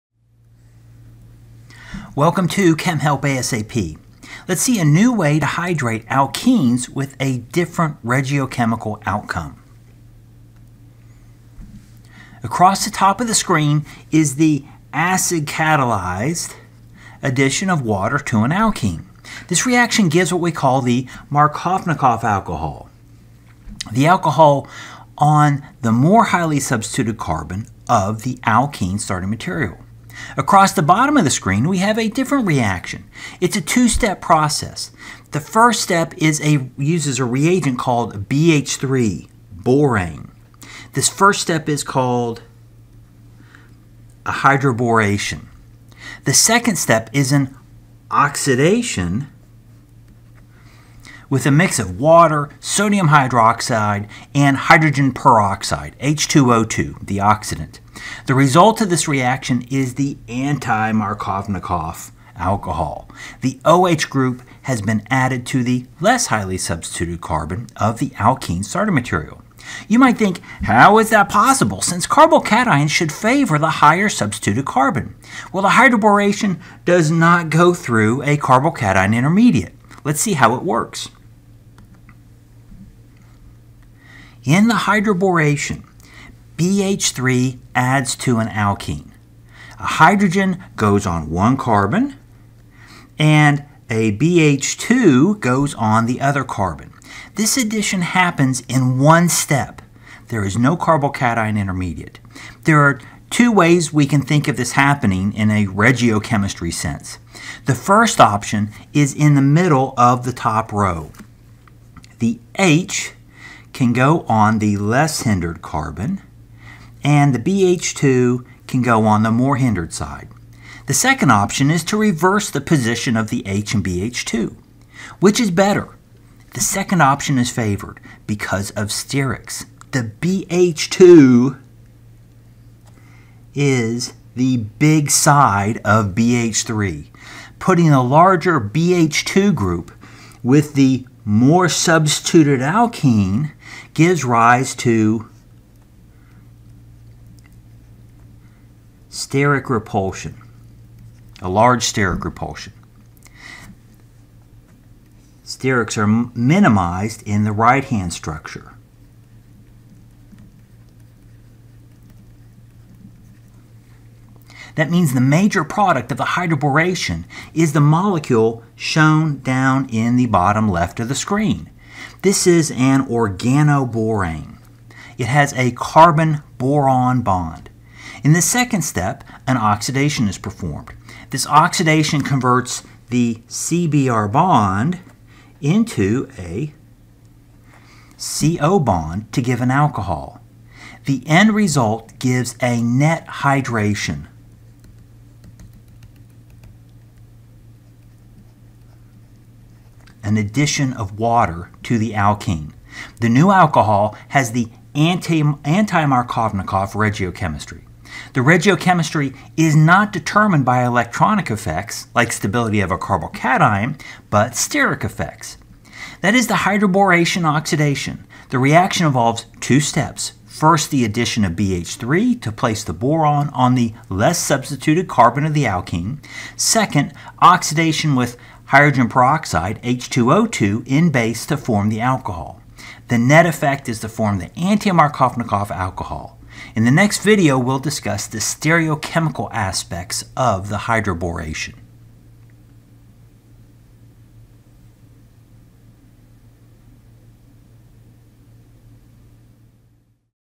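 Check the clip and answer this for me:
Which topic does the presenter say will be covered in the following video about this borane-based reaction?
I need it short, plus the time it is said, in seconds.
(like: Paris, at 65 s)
stereochemical aspects, at 238 s.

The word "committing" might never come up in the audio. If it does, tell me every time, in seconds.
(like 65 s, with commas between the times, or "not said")
not said.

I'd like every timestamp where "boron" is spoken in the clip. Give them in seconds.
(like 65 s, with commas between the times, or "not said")
175 s, 222 s.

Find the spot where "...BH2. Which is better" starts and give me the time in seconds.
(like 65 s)
123 s.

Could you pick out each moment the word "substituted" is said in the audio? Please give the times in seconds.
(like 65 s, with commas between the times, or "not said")
26 s, 66 s, 74 s, 141 s, 224 s.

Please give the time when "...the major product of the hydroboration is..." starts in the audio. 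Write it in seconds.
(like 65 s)
165 s.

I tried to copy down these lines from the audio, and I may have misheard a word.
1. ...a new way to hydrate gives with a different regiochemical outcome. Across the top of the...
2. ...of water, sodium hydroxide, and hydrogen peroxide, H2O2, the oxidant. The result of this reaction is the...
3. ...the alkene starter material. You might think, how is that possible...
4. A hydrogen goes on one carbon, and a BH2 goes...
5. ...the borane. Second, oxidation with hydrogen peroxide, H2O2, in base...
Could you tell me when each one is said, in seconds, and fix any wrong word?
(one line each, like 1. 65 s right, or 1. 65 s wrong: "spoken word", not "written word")
1. 4 s wrong: "alkenes", not "gives"
2. 51 s right
3. 67 s right
4. 89 s right
5. 225 s wrong: "alkene", not "borane".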